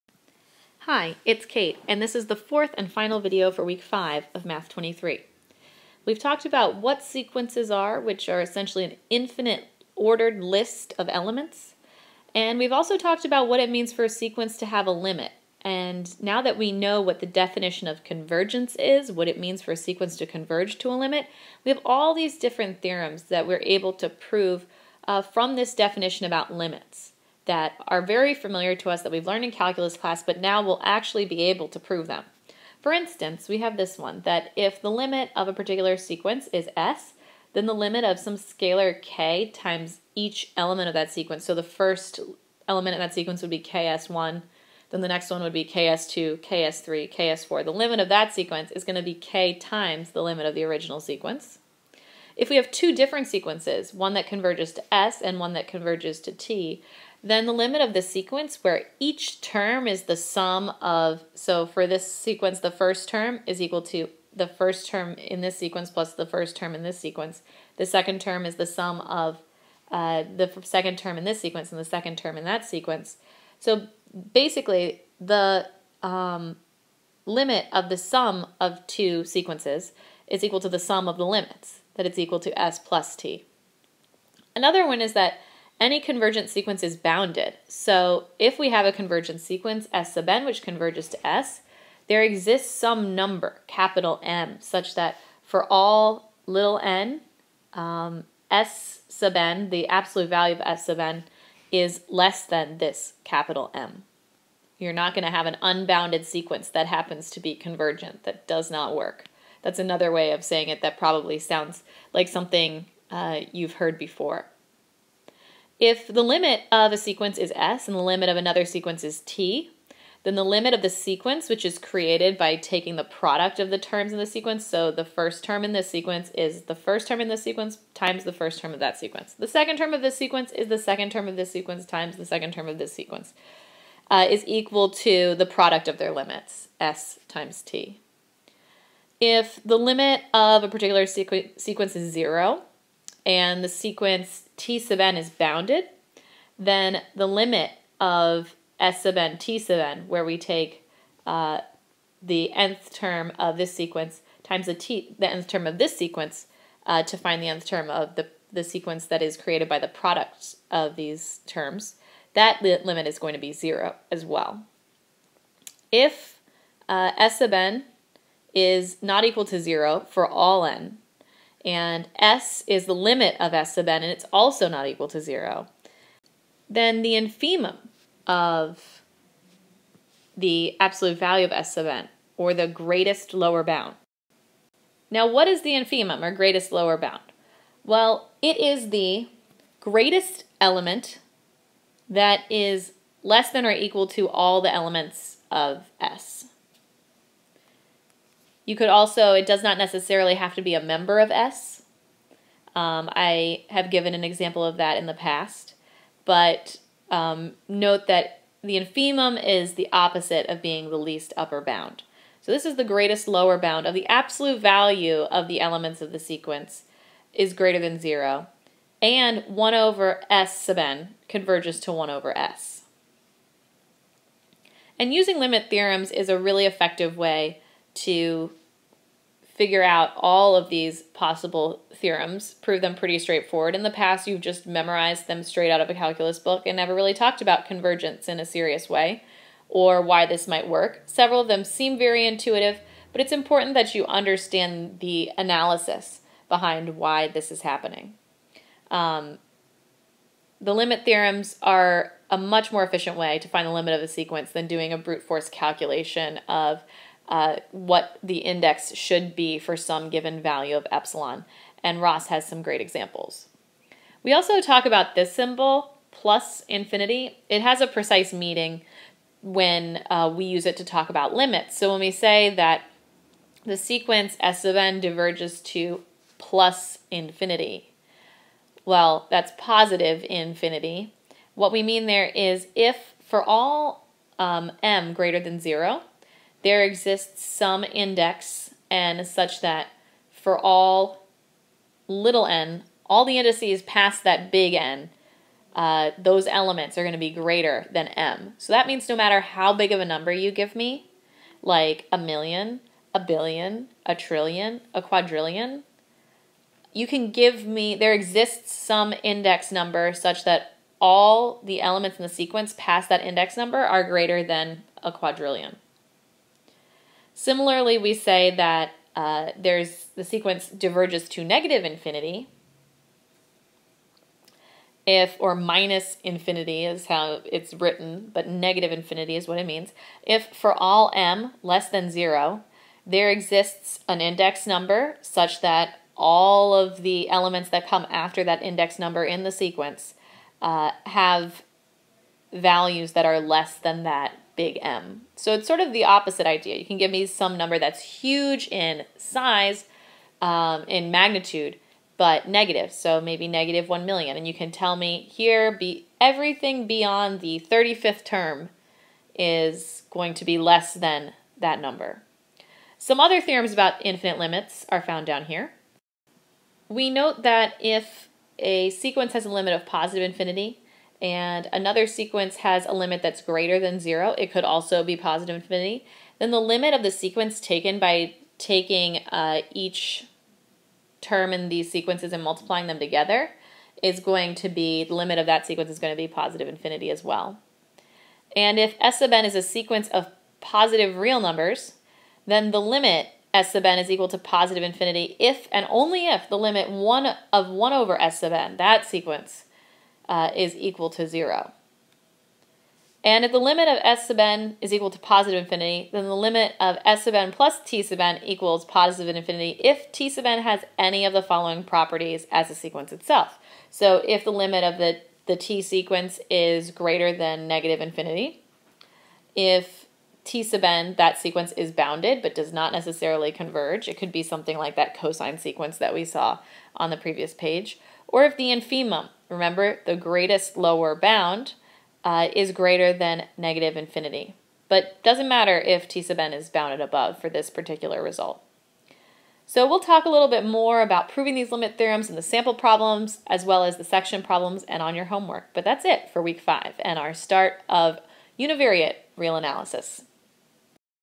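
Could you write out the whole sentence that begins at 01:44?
You're not going to have an unbounded sequence that happens to be convergent.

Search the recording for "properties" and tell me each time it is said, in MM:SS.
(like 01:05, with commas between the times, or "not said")
06:51.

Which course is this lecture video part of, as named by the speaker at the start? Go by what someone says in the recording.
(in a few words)
Math 23.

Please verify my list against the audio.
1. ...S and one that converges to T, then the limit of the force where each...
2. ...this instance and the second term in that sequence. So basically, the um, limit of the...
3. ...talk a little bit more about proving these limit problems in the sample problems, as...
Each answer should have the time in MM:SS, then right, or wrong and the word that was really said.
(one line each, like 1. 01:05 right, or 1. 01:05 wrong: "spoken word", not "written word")
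1. 00:54 wrong: "sequence", not "force"
2. 01:11 wrong: "sequence", not "instance"
3. 07:19 wrong: "theorems", not "problems".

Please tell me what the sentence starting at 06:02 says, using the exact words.
Some other theorems about infinite limits are found down here.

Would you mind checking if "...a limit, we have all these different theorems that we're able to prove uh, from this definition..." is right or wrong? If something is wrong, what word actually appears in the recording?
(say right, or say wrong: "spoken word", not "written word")
right.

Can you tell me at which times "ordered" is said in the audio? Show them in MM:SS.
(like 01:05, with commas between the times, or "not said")
00:09.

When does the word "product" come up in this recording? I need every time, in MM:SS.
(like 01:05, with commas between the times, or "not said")
02:03, 02:15, 02:39.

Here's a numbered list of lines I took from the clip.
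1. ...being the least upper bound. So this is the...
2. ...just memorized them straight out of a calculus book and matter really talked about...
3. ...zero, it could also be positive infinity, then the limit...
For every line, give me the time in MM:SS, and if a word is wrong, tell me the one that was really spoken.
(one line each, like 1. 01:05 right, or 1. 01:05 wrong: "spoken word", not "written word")
1. 03:30 right
2. 03:54 wrong: "never", not "matter"
3. 06:13 right.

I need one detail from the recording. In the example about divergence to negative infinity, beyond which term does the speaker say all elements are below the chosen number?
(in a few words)
35th term.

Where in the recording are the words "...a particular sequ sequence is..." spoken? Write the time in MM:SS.
02:20.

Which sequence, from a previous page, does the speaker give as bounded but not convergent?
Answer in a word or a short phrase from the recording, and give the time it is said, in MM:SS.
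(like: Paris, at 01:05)
cosine sequence, at 07:05.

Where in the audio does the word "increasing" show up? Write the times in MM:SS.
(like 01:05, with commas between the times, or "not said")
not said.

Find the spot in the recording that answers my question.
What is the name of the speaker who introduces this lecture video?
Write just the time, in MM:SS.
00:01.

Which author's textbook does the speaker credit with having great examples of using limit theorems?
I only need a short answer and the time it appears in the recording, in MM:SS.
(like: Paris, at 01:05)
Ross, at 04:22.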